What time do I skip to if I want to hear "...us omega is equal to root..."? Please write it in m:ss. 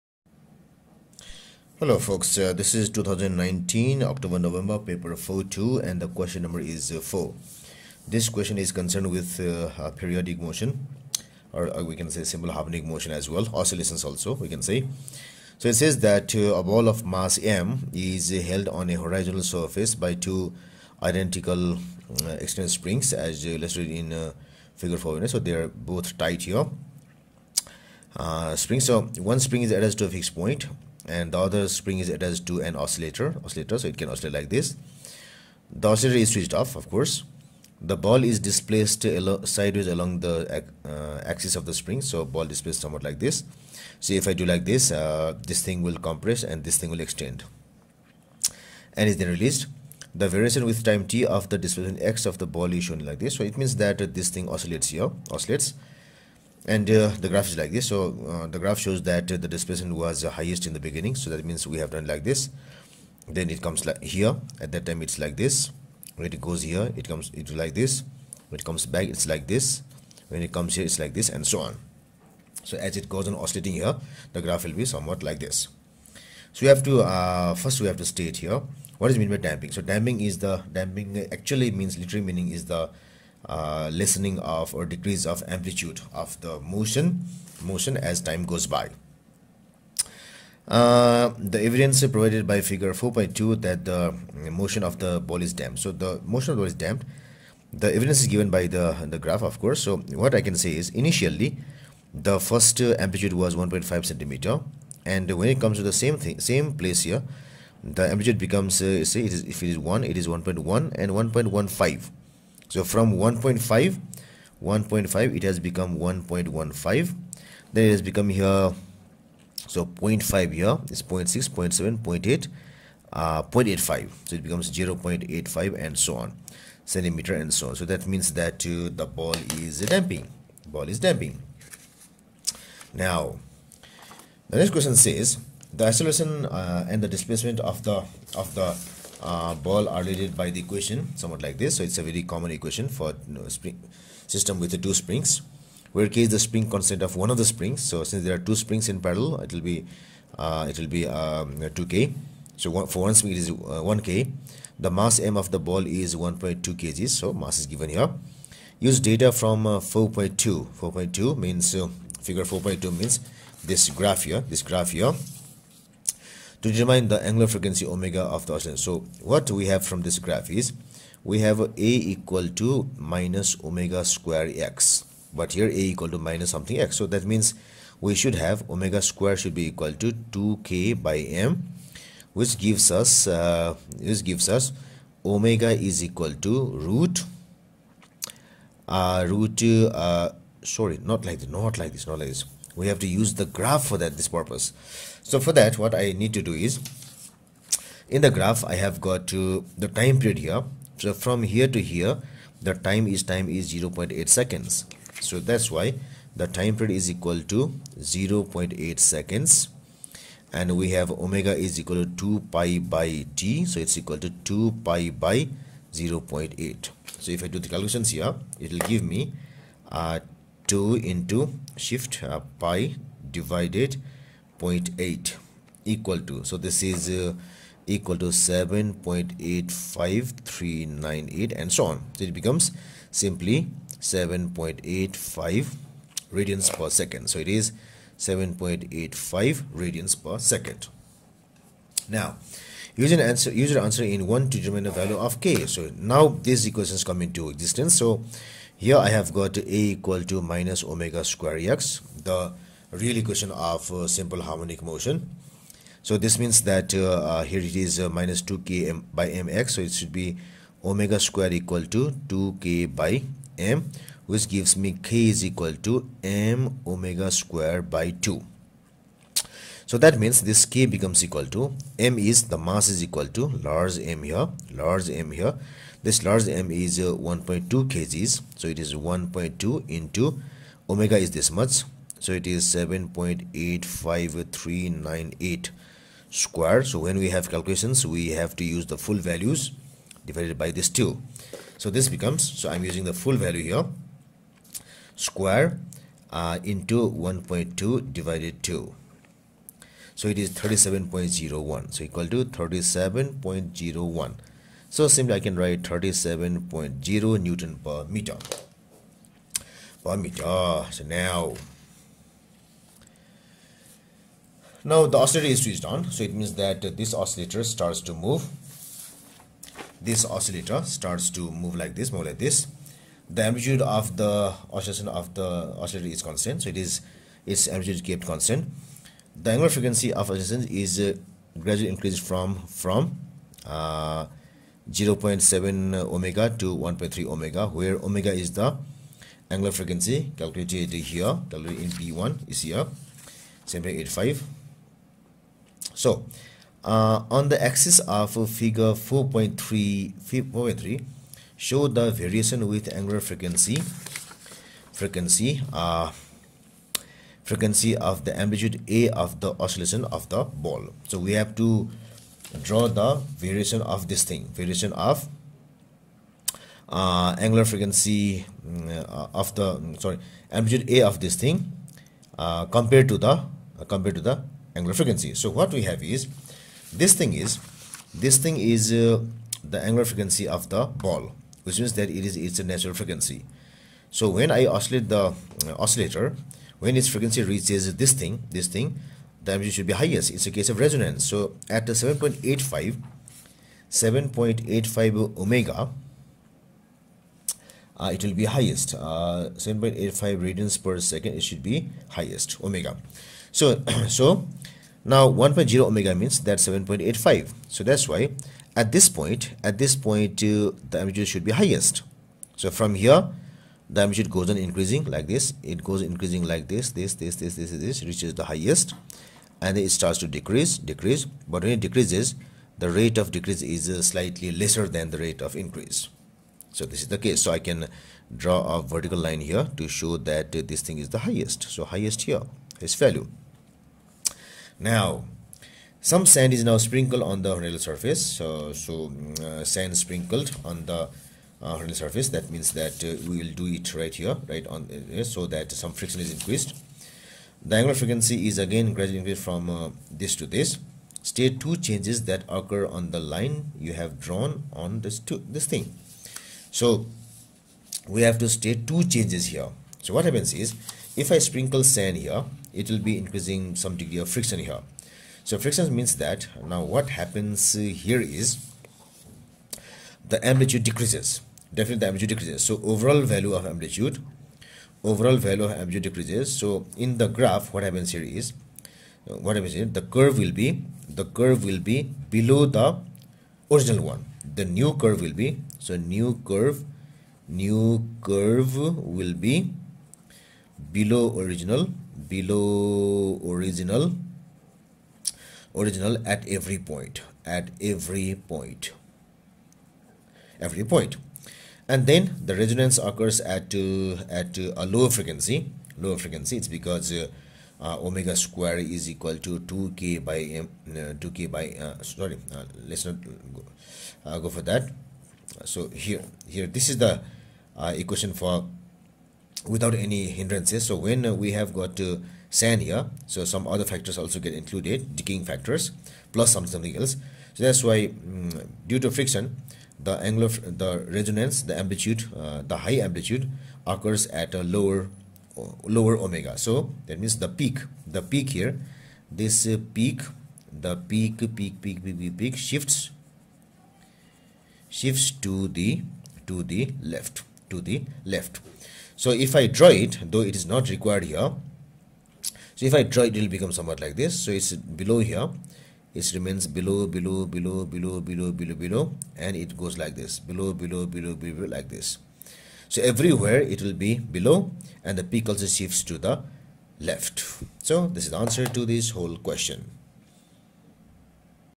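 3:04.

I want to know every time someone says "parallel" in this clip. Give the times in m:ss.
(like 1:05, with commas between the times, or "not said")
2:28.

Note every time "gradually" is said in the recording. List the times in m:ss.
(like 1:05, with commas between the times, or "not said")
5:31, 7:28.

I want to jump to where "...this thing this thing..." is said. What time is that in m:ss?
6:27.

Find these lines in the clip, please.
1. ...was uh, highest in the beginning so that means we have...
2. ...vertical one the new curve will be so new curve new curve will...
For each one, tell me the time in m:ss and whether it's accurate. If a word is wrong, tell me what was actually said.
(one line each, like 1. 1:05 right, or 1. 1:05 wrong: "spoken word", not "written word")
1. 0:59 right
2. 8:03 wrong: "original", not "vertical".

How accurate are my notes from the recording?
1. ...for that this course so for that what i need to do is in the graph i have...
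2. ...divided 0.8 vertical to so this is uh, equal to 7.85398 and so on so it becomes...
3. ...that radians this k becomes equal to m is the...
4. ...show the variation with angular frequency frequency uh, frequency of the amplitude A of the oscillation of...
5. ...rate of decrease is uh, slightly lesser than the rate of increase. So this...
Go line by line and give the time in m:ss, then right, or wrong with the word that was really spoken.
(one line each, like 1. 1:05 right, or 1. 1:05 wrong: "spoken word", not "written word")
1. 3:13 wrong: "purpose", not "course"
2. 3:43 wrong: "equal", not "vertical"
3. 4:29 wrong: "means", not "radians"
4. 5:51 right
5. 7:02 right.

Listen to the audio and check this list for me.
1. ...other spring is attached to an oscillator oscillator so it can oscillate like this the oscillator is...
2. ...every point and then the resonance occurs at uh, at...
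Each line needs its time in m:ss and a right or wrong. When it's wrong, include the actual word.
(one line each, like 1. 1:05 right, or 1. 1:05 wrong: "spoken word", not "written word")
1. 0:31 right
2. 8:20 right.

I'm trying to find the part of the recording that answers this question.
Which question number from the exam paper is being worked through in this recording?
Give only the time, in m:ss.
0:05.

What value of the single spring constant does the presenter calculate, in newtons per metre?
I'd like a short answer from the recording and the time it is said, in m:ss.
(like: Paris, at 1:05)
37.0 N/m, at 5:05.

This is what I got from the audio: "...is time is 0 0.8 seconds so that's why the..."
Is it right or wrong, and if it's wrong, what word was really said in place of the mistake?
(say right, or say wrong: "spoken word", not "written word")
right.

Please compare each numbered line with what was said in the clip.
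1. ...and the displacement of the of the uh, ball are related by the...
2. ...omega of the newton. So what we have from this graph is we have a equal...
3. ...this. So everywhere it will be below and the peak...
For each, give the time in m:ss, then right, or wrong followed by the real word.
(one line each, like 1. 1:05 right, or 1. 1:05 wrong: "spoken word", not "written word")
1. 2:16 right
2. 2:47 wrong: "oscillation", not "newton"
3. 9:21 right.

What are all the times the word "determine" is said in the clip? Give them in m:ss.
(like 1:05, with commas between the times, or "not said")
2:46, 4:04.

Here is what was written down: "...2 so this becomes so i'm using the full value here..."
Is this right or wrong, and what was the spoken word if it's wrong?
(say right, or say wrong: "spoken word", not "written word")
right.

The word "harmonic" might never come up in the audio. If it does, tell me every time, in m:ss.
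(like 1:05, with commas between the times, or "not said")
0:12, 4:14.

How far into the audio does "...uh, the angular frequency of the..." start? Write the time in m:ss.
6:18.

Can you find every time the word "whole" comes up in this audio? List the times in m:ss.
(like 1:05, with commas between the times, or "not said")
9:29.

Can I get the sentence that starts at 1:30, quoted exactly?
Uh, the evidence provided by figure 4.2 that the motion of the ball is damped.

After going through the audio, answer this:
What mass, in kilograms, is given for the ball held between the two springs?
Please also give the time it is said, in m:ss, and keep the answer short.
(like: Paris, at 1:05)
1.2 kg, at 2:36.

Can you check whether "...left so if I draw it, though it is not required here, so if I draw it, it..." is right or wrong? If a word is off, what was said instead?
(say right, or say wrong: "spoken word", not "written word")
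right.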